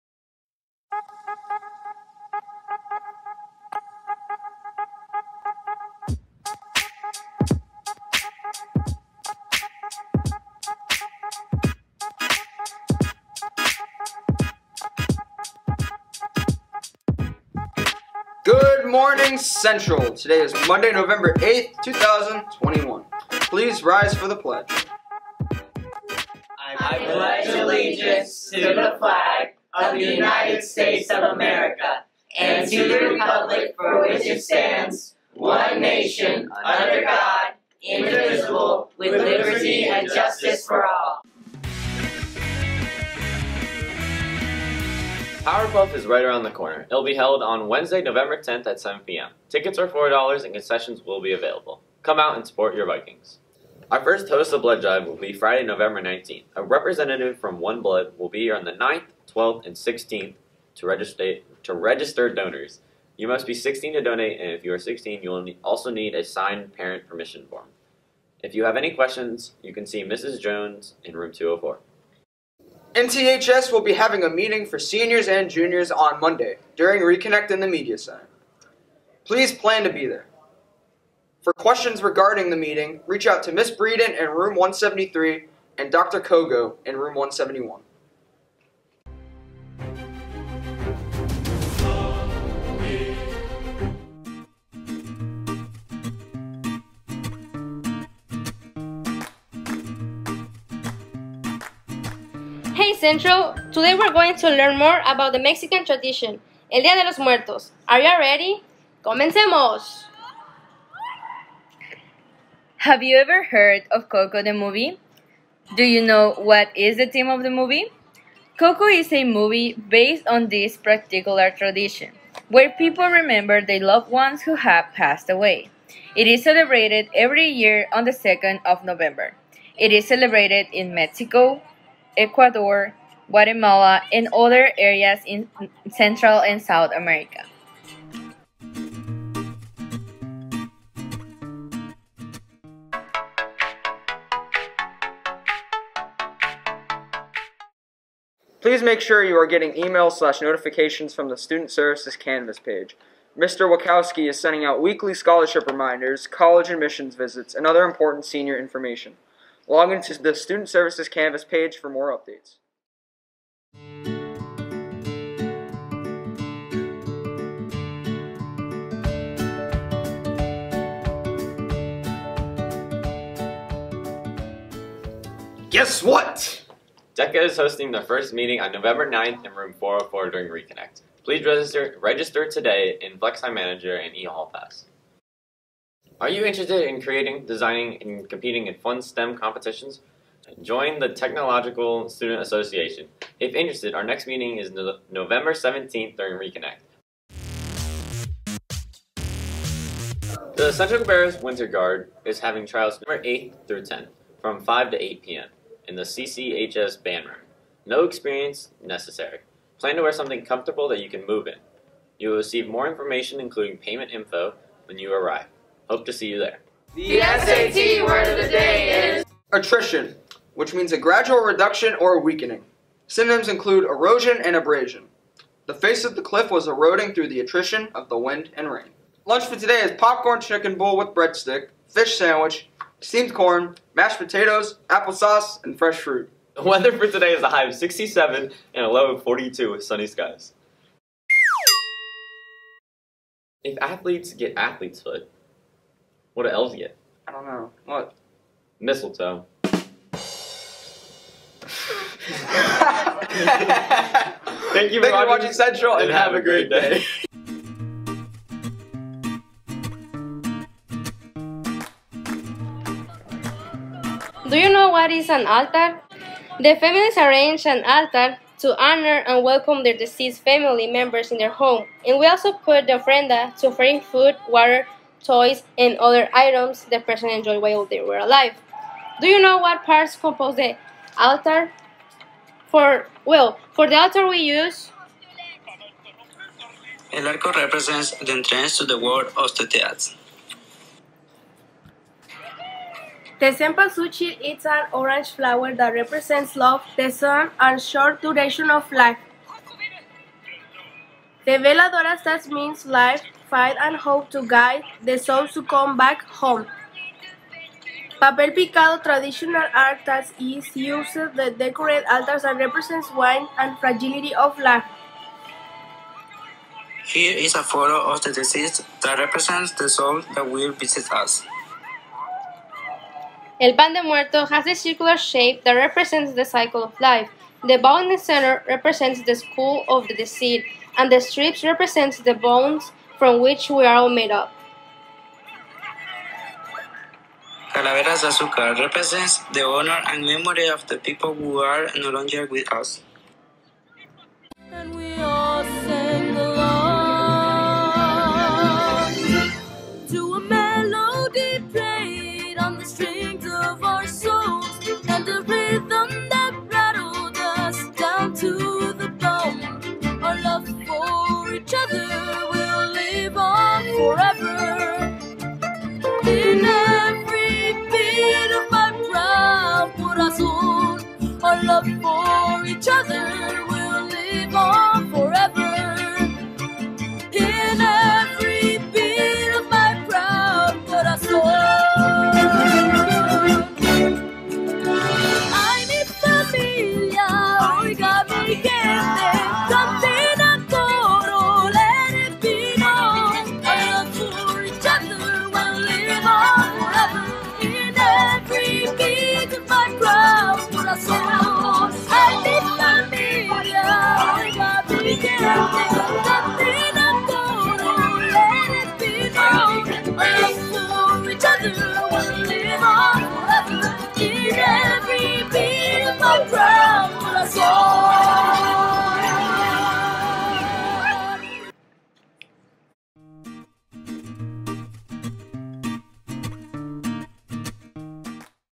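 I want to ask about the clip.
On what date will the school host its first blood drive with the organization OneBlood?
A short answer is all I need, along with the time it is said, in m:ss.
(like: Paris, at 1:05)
November 19th, at 0:55.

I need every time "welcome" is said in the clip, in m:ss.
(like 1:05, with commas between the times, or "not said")
4:29.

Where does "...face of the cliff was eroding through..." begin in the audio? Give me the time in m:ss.
3:45.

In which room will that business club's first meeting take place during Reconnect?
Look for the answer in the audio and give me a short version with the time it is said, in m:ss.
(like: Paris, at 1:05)
Room 404, at 2:59.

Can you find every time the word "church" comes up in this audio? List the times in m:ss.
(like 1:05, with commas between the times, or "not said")
not said.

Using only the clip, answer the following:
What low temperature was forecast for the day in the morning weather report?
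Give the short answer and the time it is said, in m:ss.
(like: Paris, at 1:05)
42, at 3:58.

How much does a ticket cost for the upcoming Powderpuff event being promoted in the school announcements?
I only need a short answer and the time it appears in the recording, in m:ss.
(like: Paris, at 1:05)
$4, at 0:49.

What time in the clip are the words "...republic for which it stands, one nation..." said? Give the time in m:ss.
0:33.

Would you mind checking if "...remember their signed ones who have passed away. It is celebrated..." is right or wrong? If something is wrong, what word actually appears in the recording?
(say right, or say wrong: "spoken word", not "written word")
wrong: "loved", not "signed".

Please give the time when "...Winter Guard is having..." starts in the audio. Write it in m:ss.
3:21.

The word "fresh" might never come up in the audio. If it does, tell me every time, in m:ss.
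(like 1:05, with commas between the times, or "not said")
3:55.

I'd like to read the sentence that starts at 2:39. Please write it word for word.
Log into the Student Services Canvas page for more updates.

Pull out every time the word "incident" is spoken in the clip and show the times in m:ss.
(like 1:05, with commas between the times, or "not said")
not said.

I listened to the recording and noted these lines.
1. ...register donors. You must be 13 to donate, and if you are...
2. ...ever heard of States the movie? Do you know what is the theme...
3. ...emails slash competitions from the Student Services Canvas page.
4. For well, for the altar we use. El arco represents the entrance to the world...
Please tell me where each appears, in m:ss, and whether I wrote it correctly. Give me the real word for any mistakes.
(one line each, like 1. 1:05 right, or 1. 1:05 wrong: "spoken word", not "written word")
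1. 1:01 wrong: "16", not "13"
2. 1:53 wrong: "Coco", not "States"
3. 2:29 wrong: "notifications", not "competitions"
4. 4:42 right.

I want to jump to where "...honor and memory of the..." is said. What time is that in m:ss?
5:39.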